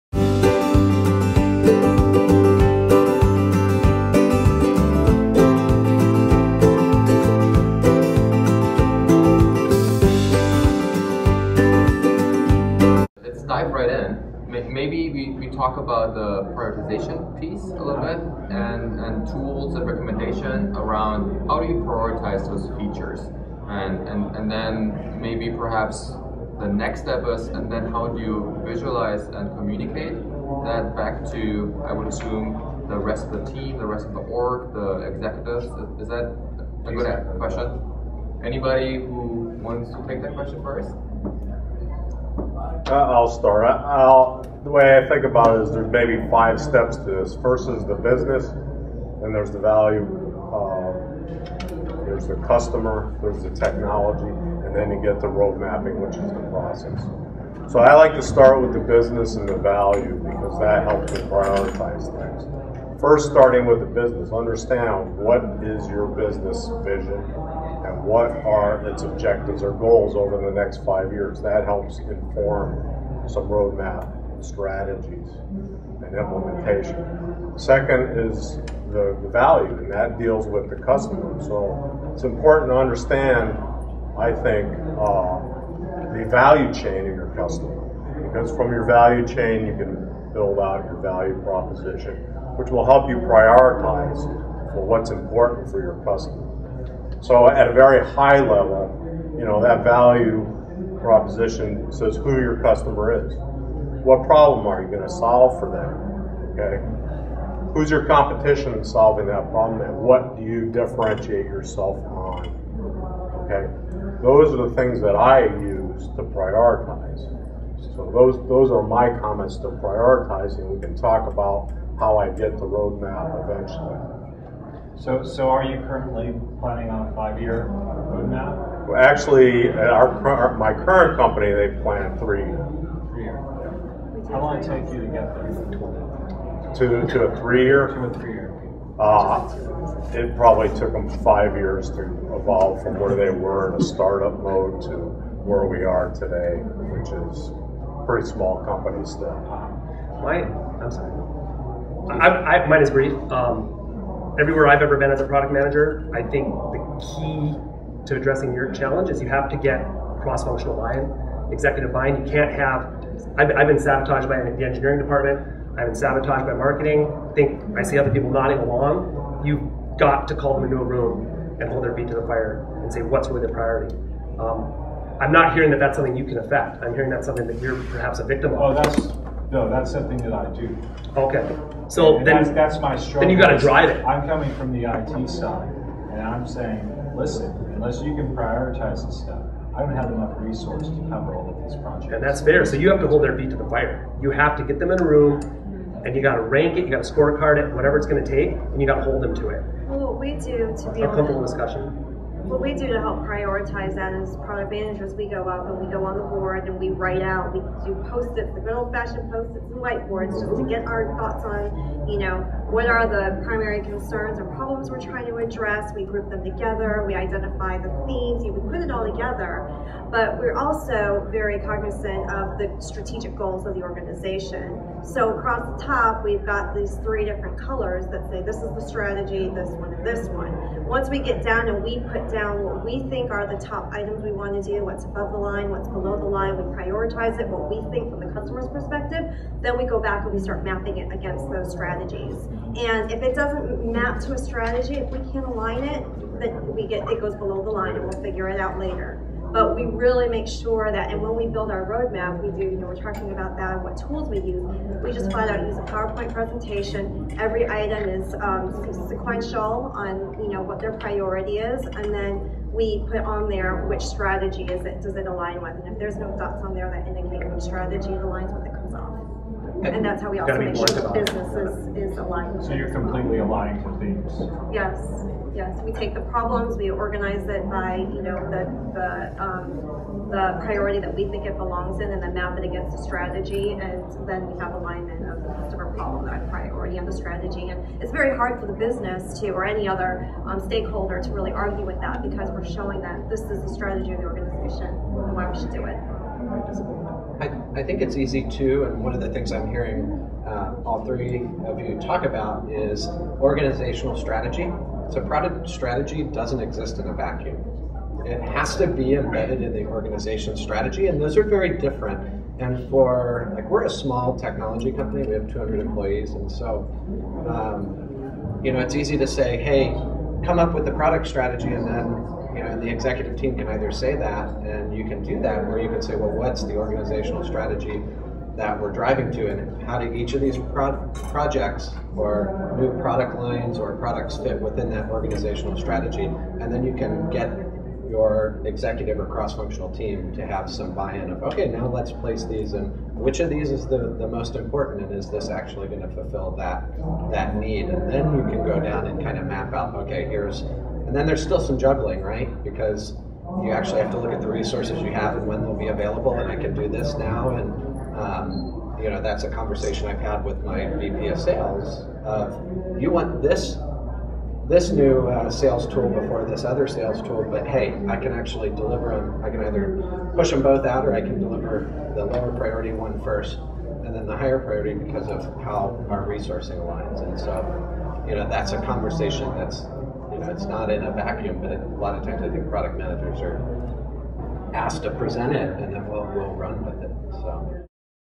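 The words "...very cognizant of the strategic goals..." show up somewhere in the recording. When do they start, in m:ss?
3:41.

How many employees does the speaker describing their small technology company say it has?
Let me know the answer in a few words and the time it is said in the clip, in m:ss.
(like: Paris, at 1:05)
200, at 5:15.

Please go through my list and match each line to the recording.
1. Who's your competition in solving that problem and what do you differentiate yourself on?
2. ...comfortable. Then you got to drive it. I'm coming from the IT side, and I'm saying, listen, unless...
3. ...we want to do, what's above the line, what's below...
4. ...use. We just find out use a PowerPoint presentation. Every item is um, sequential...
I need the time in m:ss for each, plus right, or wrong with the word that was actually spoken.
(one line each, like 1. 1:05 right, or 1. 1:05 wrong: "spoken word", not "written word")
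1. 1:47 right
2. 3:02 wrong: "struggle", not "comfortable"
3. 3:54 right
4. 4:14 right.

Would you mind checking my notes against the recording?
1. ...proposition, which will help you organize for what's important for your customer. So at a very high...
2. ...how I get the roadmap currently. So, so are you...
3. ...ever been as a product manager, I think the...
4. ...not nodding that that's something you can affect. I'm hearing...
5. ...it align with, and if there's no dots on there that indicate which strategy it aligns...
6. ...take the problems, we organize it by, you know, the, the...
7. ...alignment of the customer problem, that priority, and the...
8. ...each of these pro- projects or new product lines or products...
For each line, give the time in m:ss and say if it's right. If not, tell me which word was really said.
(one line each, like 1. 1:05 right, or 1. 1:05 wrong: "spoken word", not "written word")
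1. 1:31 wrong: "prioritize", not "organize"
2. 2:01 wrong: "eventually", not "currently"
3. 2:34 right
4. 2:55 wrong: "hearing", not "nodding"
5. 4:25 right
6. 4:35 right
7. 4:44 right
8. 5:30 right.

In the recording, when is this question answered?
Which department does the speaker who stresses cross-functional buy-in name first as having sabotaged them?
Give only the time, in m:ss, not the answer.
2:44.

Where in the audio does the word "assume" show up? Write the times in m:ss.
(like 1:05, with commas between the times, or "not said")
0:32.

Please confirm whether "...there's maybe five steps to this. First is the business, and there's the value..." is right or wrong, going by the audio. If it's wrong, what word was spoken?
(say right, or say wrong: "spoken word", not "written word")
right.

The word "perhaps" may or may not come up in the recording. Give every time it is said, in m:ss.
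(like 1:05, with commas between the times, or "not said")
0:25, 2:57.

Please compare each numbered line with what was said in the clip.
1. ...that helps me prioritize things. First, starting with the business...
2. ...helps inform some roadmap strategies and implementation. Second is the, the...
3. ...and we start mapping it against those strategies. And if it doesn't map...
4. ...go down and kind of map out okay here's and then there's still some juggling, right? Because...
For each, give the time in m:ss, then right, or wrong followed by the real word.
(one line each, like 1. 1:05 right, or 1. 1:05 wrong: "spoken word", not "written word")
1. 1:00 right
2. 1:11 right
3. 4:00 right
4. 5:48 right.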